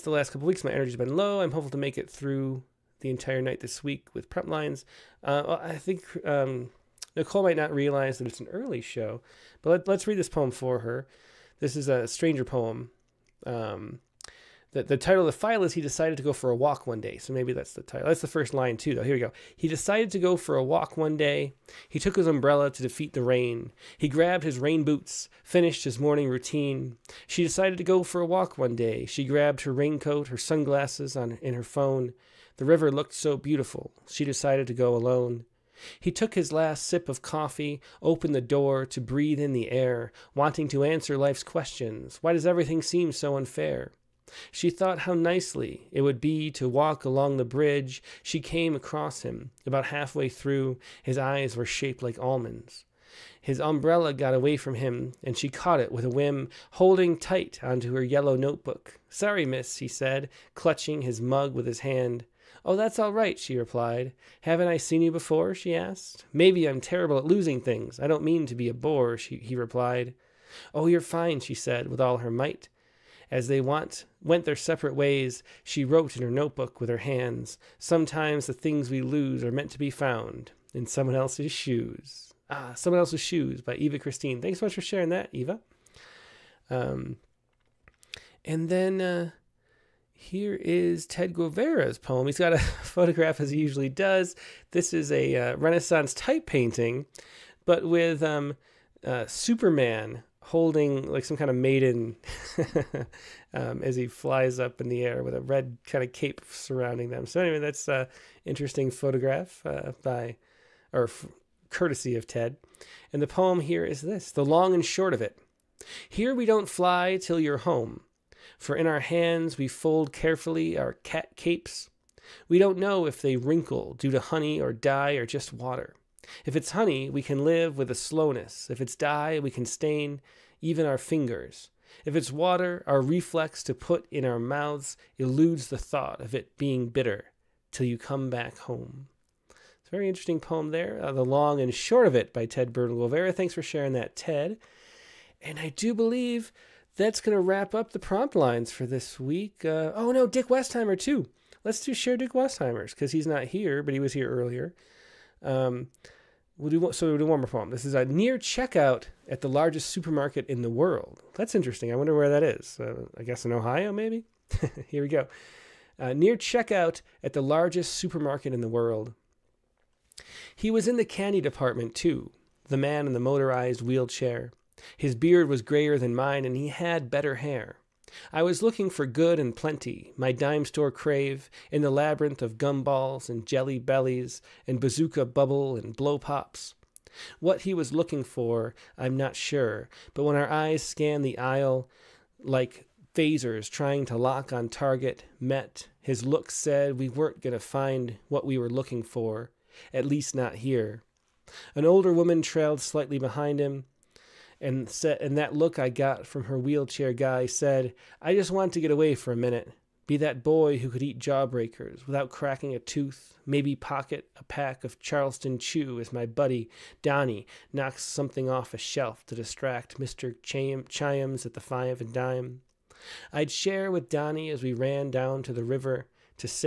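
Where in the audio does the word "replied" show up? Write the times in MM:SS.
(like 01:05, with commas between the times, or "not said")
01:03, 01:09.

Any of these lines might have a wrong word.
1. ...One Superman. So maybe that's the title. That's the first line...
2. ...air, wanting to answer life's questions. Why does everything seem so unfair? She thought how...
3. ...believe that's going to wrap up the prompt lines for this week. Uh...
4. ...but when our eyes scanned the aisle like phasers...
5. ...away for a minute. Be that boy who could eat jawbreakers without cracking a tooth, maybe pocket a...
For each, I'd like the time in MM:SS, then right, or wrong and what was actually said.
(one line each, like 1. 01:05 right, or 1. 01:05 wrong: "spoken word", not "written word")
1. 00:16 wrong: "Day", not "Superman"
2. 00:39 right
3. 02:25 right
4. 03:10 right
5. 03:28 right.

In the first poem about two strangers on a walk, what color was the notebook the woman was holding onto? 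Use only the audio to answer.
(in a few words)
yellow.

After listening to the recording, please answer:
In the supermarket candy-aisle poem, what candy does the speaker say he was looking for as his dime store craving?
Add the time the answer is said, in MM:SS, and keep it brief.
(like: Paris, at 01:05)
Good and Plenty, at 02:59.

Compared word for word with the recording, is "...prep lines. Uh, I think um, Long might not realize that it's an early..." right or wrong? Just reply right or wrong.
wrong.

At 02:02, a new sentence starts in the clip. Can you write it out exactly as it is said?
We don't know if they wrinkle due to honey or dye or just water.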